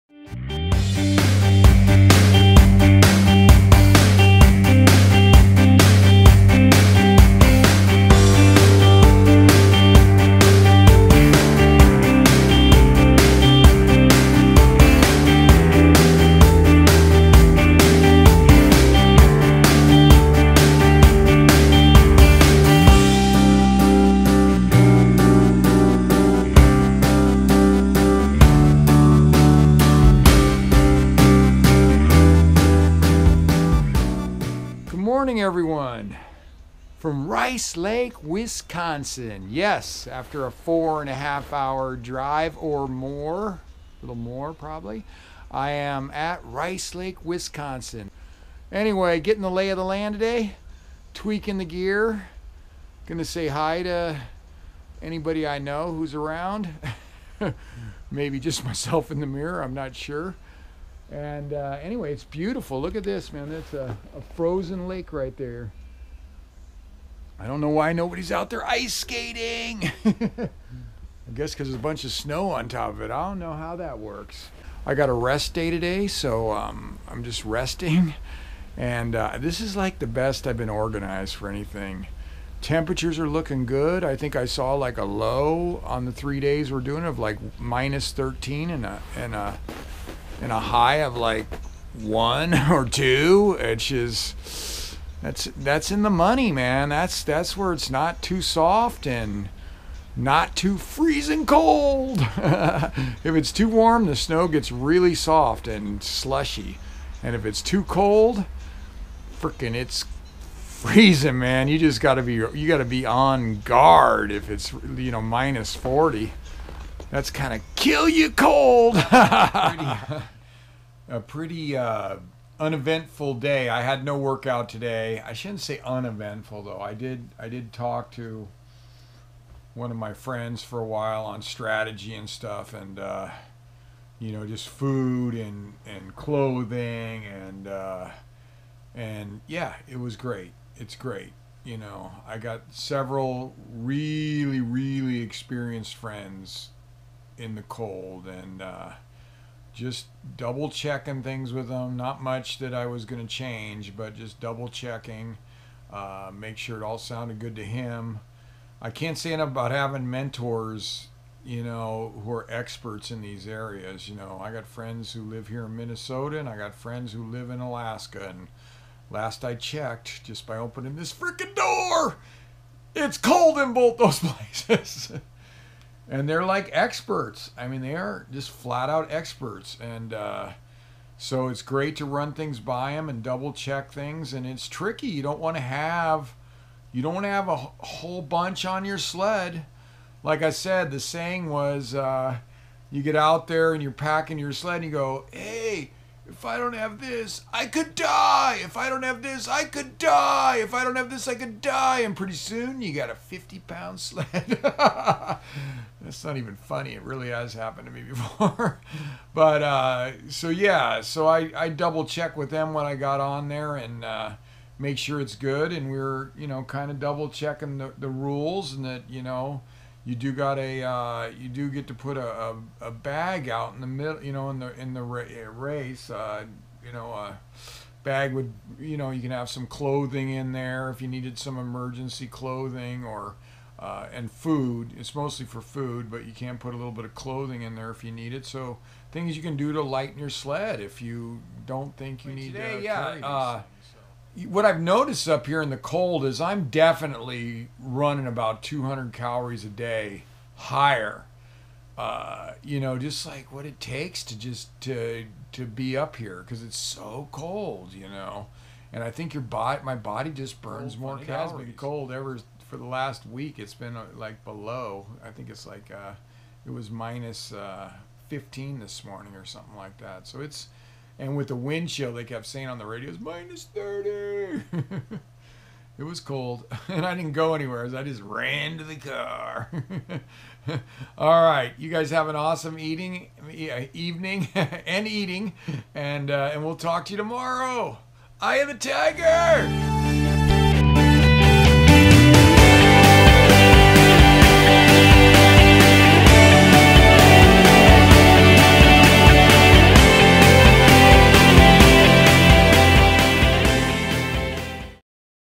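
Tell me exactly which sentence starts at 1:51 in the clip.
You just got to be you got to be on guard if it's you know minus forty.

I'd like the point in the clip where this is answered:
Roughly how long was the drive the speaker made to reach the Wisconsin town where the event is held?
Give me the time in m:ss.
0:40.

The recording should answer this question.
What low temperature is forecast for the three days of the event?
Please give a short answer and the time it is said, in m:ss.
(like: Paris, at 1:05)
-13, at 1:27.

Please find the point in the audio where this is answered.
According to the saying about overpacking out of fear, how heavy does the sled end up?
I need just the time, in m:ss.
3:23.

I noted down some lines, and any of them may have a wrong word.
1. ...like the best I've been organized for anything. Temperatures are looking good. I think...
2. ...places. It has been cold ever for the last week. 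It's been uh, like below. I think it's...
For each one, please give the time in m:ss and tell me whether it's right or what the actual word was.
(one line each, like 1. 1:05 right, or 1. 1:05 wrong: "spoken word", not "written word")
1. 1:19 right
2. 4:21 wrong: "calories", not "places".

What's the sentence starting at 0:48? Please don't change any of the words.
Anyway, getting the lay of the land today, tweaking the gear.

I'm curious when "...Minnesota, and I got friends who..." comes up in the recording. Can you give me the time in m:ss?
2:45.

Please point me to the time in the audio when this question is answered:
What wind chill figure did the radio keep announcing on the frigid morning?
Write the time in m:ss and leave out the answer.
4:33.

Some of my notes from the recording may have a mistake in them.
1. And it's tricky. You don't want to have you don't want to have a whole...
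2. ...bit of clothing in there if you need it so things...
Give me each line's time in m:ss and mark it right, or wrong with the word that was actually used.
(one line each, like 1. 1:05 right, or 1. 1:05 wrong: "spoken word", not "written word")
1. 3:04 right
2. 3:56 right.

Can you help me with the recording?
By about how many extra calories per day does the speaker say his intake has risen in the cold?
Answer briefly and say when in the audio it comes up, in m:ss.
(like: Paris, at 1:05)
200, at 4:08.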